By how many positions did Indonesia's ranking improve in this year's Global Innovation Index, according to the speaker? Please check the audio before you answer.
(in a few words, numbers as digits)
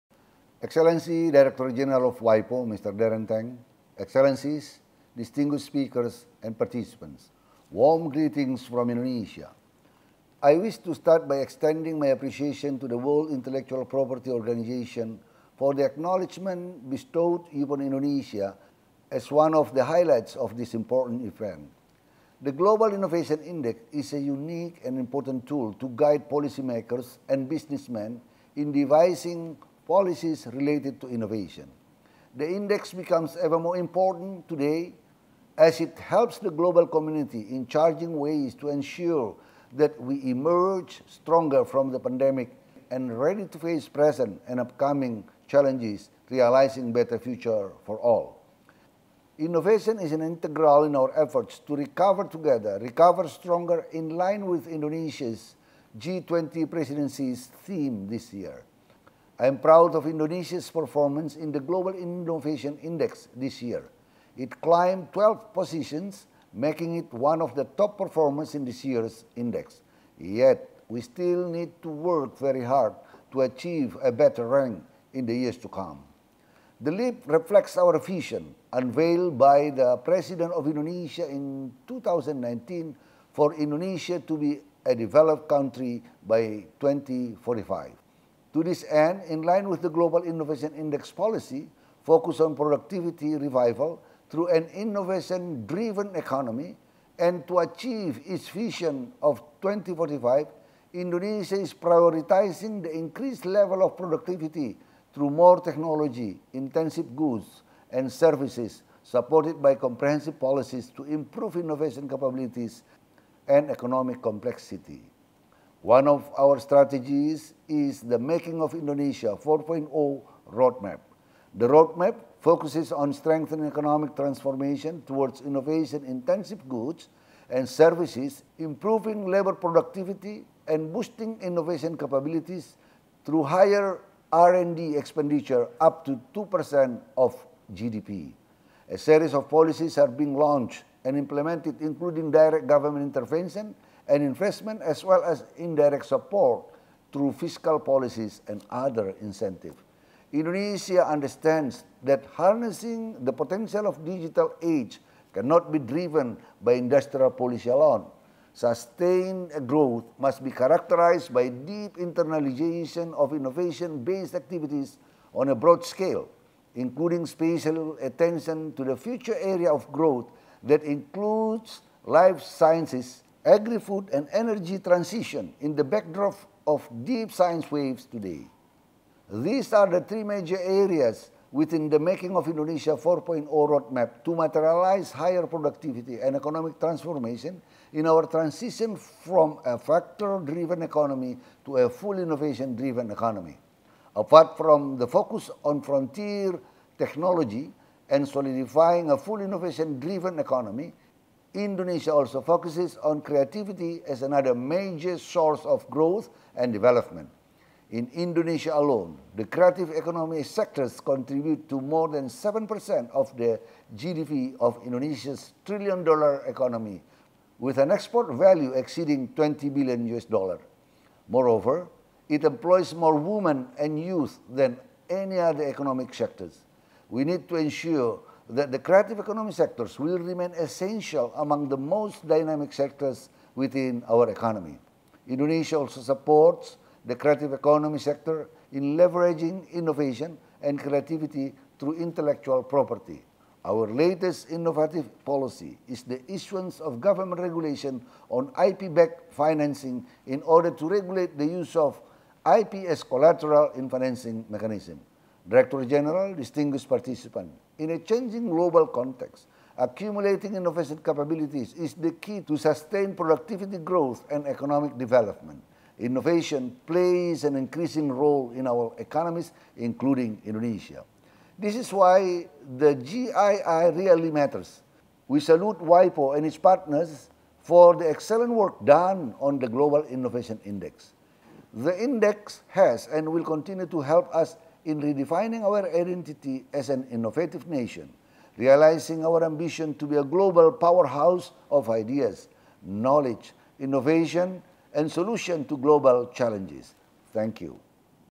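12.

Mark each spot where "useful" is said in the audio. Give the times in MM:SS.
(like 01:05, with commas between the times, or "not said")
not said.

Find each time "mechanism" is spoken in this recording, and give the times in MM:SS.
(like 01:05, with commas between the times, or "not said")
04:14.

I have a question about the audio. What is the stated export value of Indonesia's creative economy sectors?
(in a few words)
over 20 billion US dollars.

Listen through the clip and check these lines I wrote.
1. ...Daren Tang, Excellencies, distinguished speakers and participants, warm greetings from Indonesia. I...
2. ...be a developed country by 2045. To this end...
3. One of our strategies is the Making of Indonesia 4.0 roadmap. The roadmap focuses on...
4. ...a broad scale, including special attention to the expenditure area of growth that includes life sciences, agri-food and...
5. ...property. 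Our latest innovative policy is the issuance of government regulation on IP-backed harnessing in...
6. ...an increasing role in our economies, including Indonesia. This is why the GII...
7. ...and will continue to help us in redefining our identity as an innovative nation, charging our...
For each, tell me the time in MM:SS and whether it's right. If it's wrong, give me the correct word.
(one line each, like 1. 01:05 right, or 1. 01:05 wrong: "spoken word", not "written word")
1. 00:02 right
2. 01:24 right
3. 01:55 right
4. 02:45 wrong: "future", not "expenditure"
5. 04:02 wrong: "financing", not "harnessing"
6. 04:27 right
7. 04:43 wrong: "realizing", not "charging".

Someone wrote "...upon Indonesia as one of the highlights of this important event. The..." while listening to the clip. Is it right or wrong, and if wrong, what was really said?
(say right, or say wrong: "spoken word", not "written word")
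right.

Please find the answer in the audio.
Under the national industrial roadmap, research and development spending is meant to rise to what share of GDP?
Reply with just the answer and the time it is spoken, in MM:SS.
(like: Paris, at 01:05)
2%, at 02:16.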